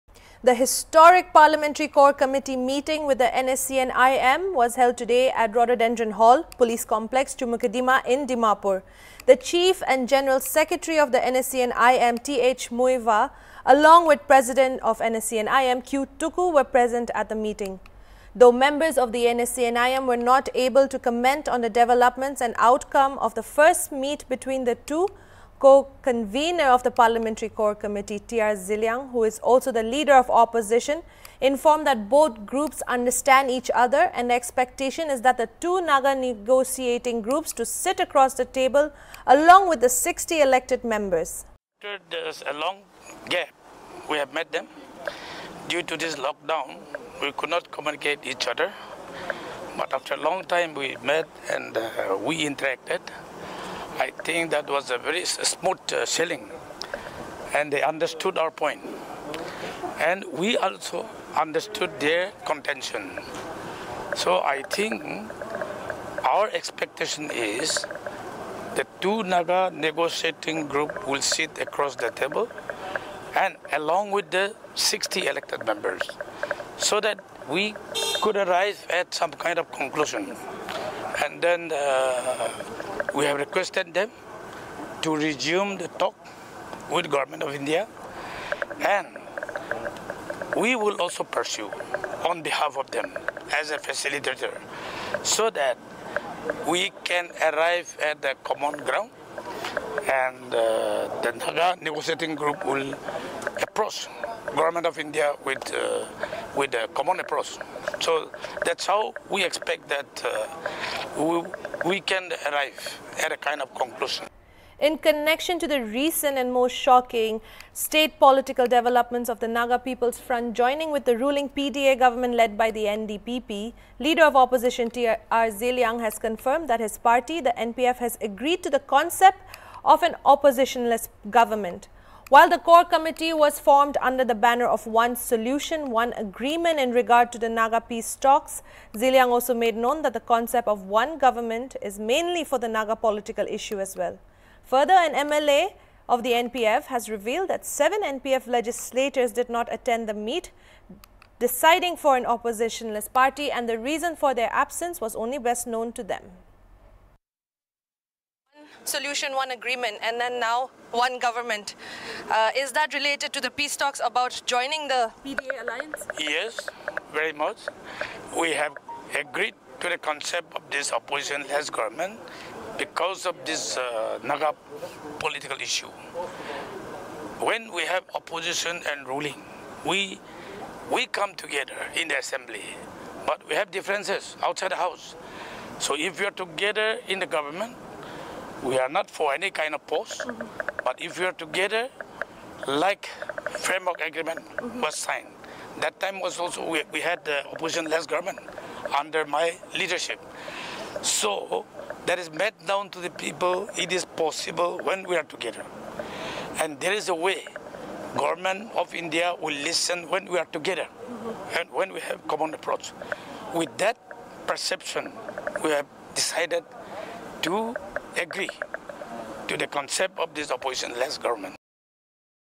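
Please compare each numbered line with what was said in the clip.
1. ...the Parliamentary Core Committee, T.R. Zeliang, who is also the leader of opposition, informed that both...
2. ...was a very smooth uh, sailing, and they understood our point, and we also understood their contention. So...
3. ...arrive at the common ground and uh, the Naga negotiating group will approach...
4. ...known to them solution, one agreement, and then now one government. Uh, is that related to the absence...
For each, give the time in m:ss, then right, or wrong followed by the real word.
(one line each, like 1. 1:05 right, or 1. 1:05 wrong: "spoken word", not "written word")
1. 0:26 right
2. 0:54 right
3. 1:37 right
4. 2:35 wrong: "peace", not "absence".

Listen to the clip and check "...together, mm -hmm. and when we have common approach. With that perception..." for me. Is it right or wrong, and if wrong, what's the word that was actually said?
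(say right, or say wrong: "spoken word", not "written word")
right.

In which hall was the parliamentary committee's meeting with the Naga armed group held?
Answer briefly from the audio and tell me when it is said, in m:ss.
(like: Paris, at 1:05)
Rhododendron Hall, at 0:05.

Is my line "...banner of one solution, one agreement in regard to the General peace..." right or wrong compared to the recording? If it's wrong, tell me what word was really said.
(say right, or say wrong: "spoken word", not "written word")
wrong: "Naga", not "General".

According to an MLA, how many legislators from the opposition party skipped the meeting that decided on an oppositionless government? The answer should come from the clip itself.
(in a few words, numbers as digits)
7.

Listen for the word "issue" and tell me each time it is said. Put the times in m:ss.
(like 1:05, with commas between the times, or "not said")
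2:23, 2:55.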